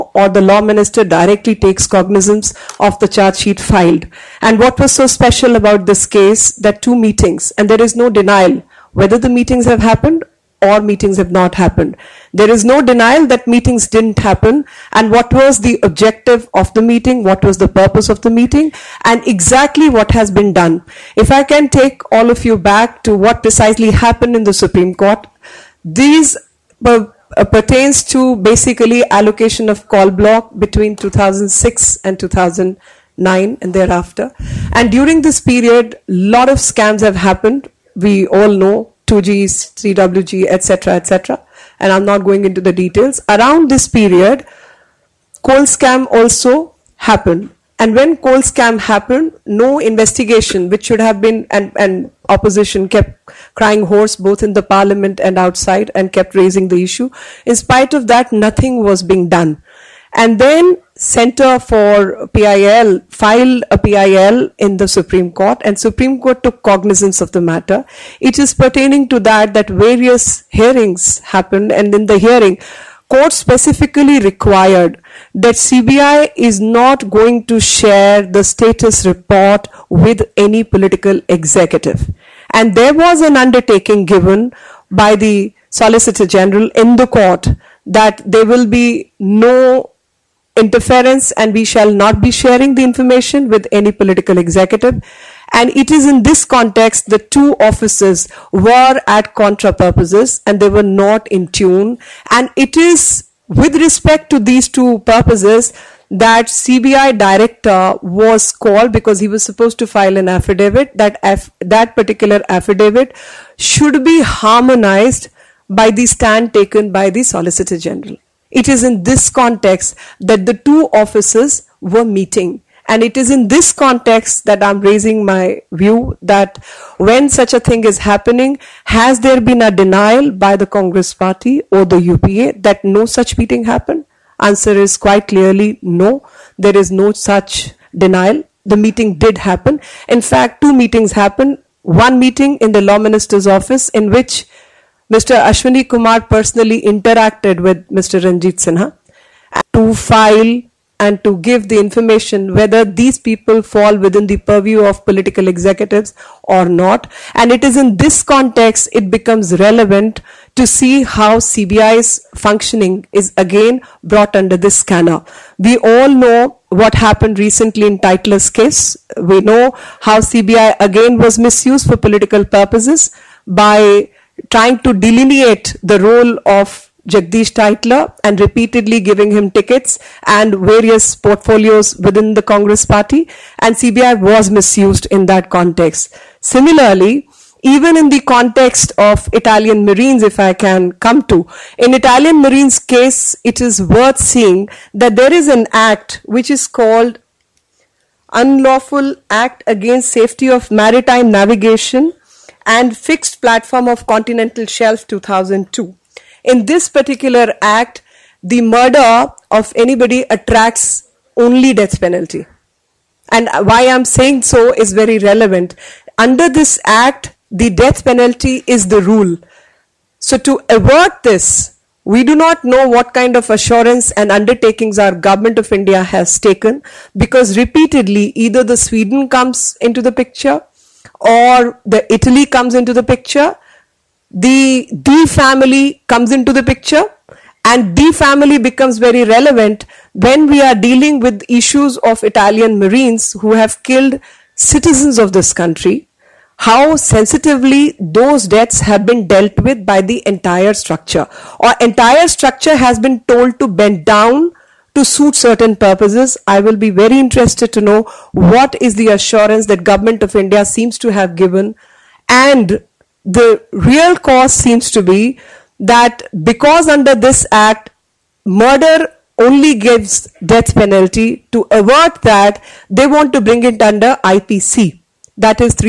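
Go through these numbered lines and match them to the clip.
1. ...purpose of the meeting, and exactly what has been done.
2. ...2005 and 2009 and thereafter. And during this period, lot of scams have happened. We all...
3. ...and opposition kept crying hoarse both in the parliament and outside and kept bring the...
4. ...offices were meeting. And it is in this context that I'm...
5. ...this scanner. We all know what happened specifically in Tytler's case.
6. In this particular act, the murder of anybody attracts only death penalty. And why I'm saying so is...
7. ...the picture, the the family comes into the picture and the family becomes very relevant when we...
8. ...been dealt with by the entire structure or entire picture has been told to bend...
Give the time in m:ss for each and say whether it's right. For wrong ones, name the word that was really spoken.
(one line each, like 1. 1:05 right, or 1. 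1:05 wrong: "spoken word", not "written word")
1. 0:17 right
2. 0:30 wrong: "2006", not "2005"
3. 0:51 wrong: "raising", not "bring"
4. 2:00 right
5. 2:44 wrong: "recently", not "specifically"
6. 3:26 right
7. 3:52 right
8. 4:09 wrong: "structure", not "picture".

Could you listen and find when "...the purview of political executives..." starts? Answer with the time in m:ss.
2:34.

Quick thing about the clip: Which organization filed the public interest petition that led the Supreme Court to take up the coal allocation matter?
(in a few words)
Center for PIL.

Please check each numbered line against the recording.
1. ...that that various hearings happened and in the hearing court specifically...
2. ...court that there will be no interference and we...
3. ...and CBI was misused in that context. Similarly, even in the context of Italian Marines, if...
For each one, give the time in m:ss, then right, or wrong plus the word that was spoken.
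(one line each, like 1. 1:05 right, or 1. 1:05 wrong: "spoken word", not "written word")
1. 1:09 right
2. 1:27 right
3. 3:03 right.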